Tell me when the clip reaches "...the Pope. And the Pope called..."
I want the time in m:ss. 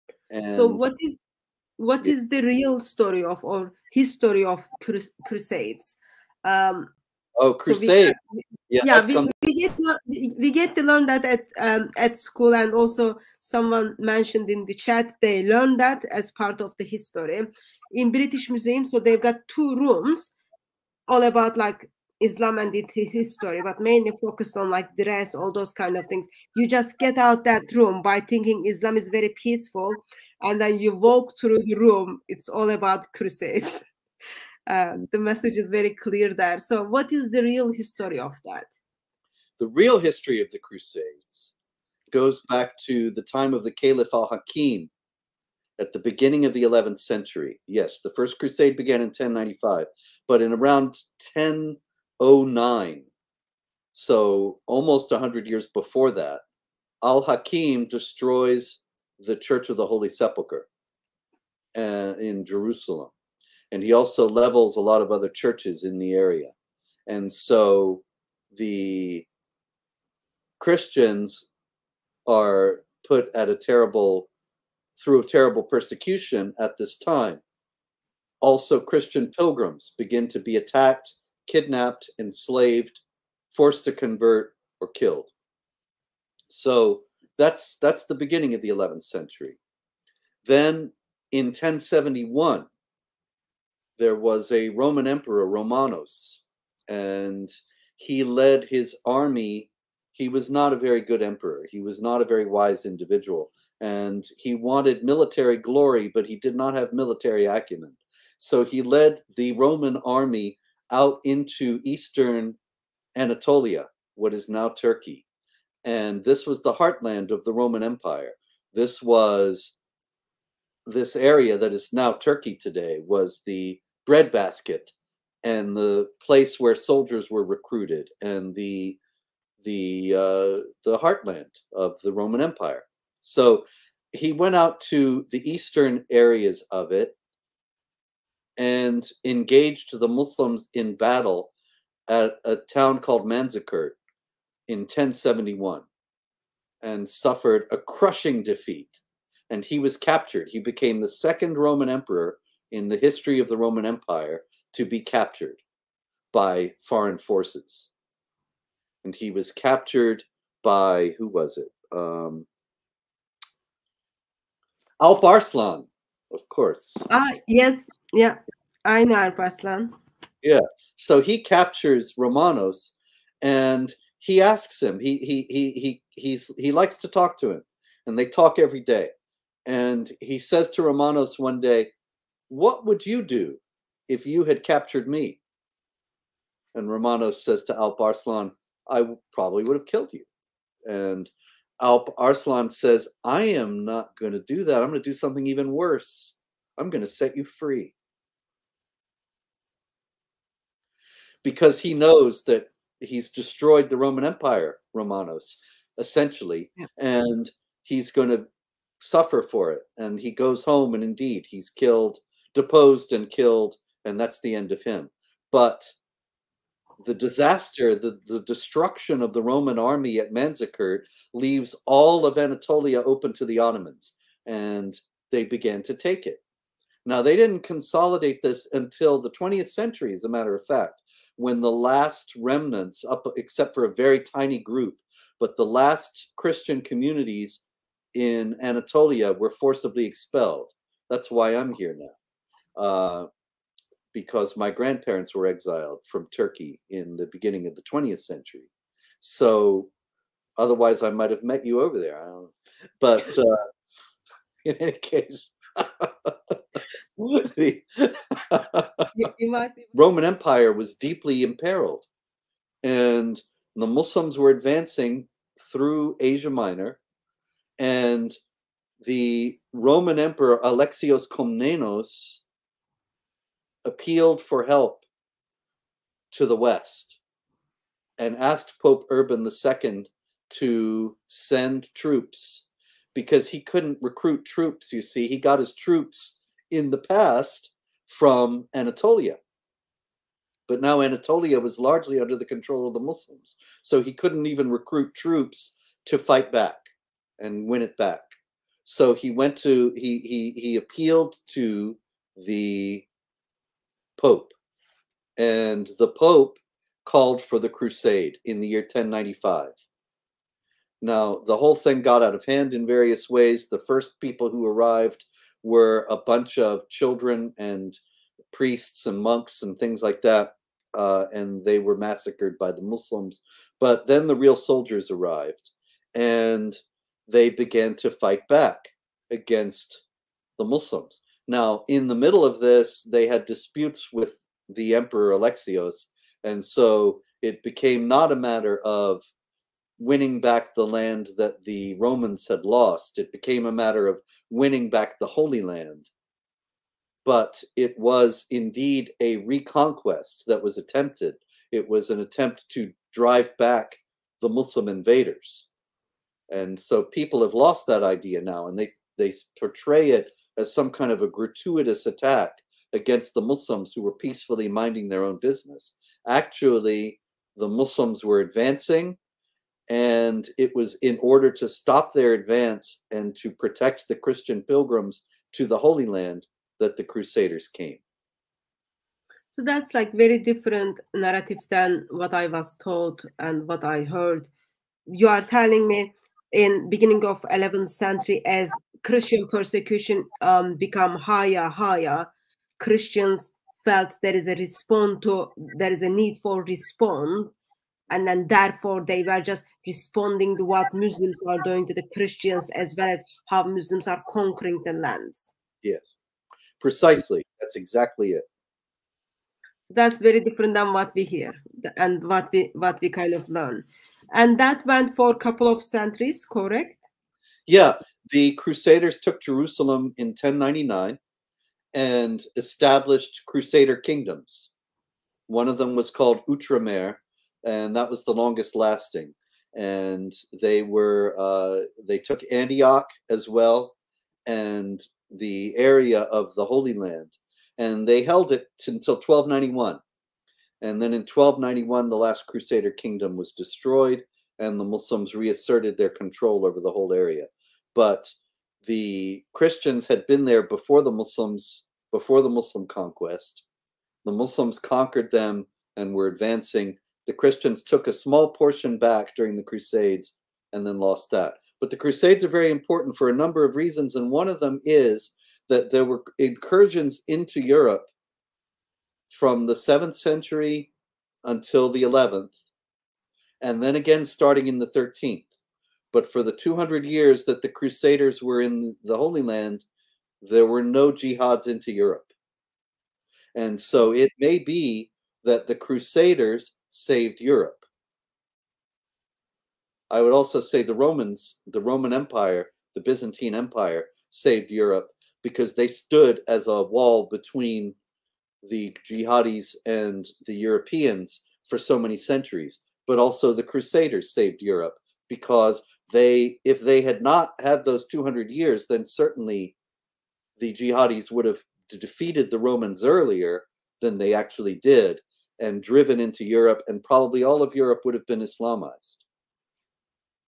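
5:02.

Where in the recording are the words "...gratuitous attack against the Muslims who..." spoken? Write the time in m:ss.
6:01.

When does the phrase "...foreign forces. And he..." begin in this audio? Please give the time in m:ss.
2:36.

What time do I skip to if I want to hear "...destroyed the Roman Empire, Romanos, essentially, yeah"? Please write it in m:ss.
3:23.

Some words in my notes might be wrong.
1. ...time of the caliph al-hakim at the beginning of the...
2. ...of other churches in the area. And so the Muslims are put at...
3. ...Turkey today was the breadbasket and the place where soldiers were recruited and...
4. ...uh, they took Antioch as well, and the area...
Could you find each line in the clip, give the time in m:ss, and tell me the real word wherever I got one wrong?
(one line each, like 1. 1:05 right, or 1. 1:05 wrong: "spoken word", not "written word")
1. 0:43 right
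2. 1:05 wrong: "Christians", not "Muslims"
3. 2:02 right
4. 7:11 right.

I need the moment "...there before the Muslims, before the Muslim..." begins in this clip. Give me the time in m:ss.
7:30.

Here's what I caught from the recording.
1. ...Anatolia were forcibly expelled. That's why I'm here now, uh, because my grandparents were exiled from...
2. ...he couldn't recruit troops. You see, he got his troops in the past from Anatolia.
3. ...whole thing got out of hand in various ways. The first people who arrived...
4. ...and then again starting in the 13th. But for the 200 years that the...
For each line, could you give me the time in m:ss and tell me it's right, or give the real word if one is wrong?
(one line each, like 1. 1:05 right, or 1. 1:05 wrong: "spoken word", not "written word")
1. 3:58 right
2. 4:43 right
3. 5:11 right
4. 7:53 right.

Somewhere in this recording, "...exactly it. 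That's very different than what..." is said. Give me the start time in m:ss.
6:47.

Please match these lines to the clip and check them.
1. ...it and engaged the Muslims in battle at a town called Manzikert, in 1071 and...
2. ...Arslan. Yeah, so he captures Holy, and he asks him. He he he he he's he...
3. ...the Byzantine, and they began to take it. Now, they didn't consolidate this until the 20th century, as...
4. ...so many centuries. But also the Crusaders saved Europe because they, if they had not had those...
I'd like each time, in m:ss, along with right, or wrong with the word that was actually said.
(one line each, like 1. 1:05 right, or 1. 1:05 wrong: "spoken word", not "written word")
1. 2:16 right
2. 2:49 wrong: "Romanos", not "Holy"
3. 3:43 wrong: "Ottomans", not "Byzantine"
4. 8:21 right.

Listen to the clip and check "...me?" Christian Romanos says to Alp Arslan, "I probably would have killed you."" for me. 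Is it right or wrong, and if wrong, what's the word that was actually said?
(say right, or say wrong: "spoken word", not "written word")
wrong: "And", not "Christian".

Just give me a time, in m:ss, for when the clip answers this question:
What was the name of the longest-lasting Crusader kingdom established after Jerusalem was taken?
7:06.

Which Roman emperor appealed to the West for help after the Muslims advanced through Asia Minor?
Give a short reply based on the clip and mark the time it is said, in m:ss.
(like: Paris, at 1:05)
Alexios Komnenos, at 4:30.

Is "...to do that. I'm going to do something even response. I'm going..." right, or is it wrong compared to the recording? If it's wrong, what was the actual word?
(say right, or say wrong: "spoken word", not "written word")
wrong: "worse", not "response".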